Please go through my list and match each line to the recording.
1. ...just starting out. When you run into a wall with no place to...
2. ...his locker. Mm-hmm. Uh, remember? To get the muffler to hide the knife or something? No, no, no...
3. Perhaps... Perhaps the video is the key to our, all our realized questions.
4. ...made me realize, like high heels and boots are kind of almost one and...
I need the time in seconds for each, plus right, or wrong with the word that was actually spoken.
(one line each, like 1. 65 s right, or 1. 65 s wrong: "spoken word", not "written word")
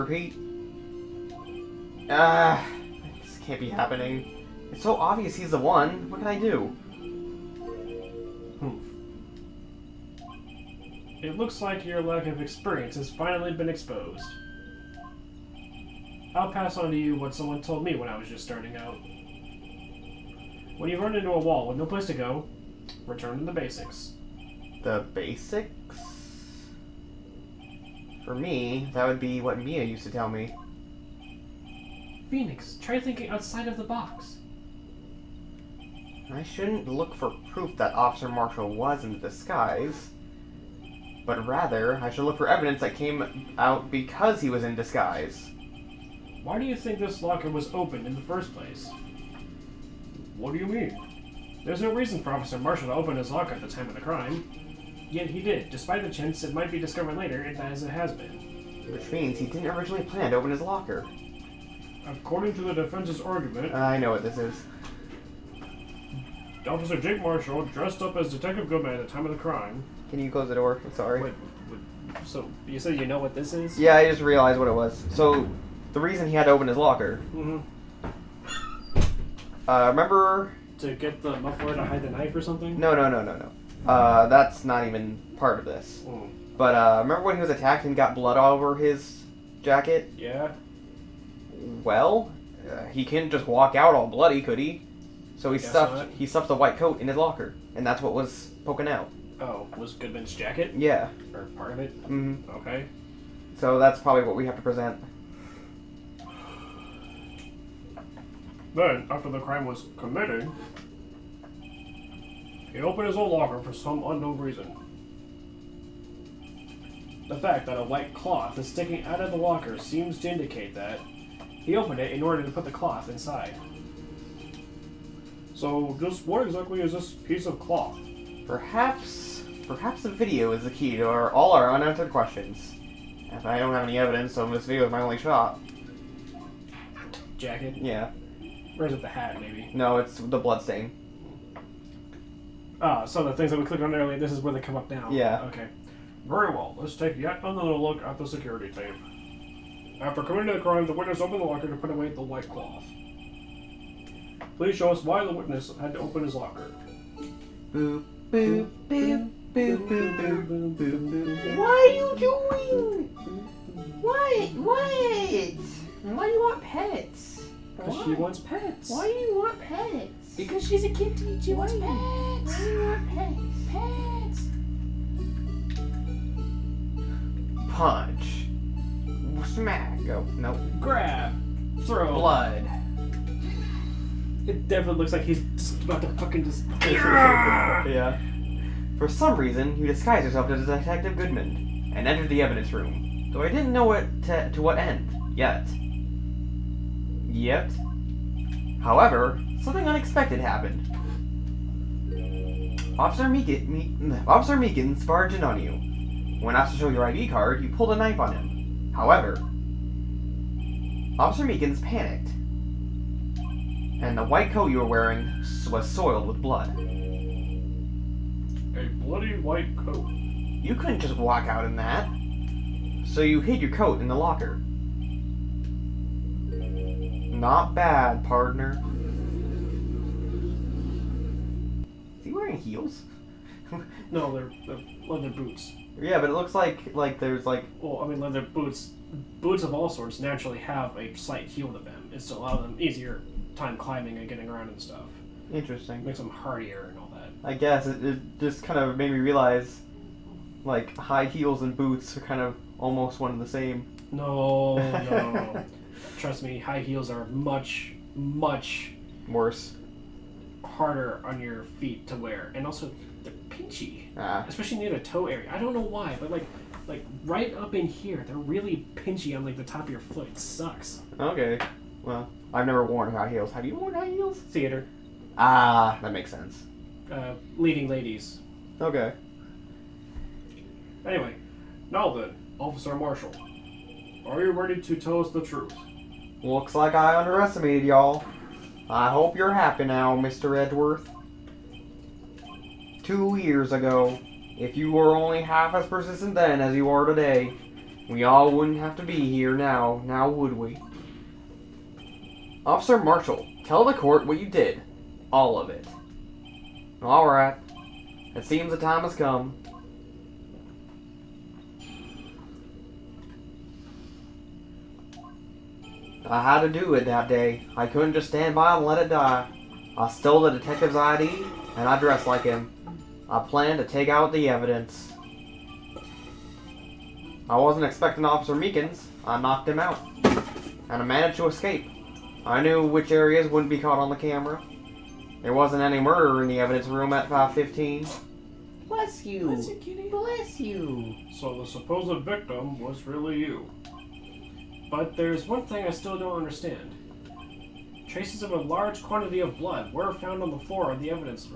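1. 18 s right
2. 76 s right
3. 128 s wrong: "unanswered", not "realized"
4. 248 s right.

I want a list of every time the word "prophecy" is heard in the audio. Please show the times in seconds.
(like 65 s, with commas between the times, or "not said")
not said.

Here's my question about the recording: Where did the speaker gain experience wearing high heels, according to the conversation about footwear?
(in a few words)
Theater.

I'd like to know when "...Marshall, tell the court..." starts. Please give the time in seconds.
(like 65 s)
302 s.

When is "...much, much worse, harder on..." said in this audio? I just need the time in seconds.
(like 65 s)
257 s.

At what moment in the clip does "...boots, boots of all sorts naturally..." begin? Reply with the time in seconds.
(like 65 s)
238 s.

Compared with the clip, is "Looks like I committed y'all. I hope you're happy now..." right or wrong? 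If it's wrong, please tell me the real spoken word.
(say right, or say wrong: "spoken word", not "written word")
wrong: "underestimated", not "committed".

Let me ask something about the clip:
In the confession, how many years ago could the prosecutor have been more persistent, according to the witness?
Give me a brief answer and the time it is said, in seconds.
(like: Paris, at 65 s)
2, at 293 s.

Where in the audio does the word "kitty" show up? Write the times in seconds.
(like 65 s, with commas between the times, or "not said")
170 s, 339 s.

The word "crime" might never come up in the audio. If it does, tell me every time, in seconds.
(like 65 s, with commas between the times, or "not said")
54 s, 69 s, 109 s, 150 s.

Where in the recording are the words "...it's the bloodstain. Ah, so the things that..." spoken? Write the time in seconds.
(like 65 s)
139 s.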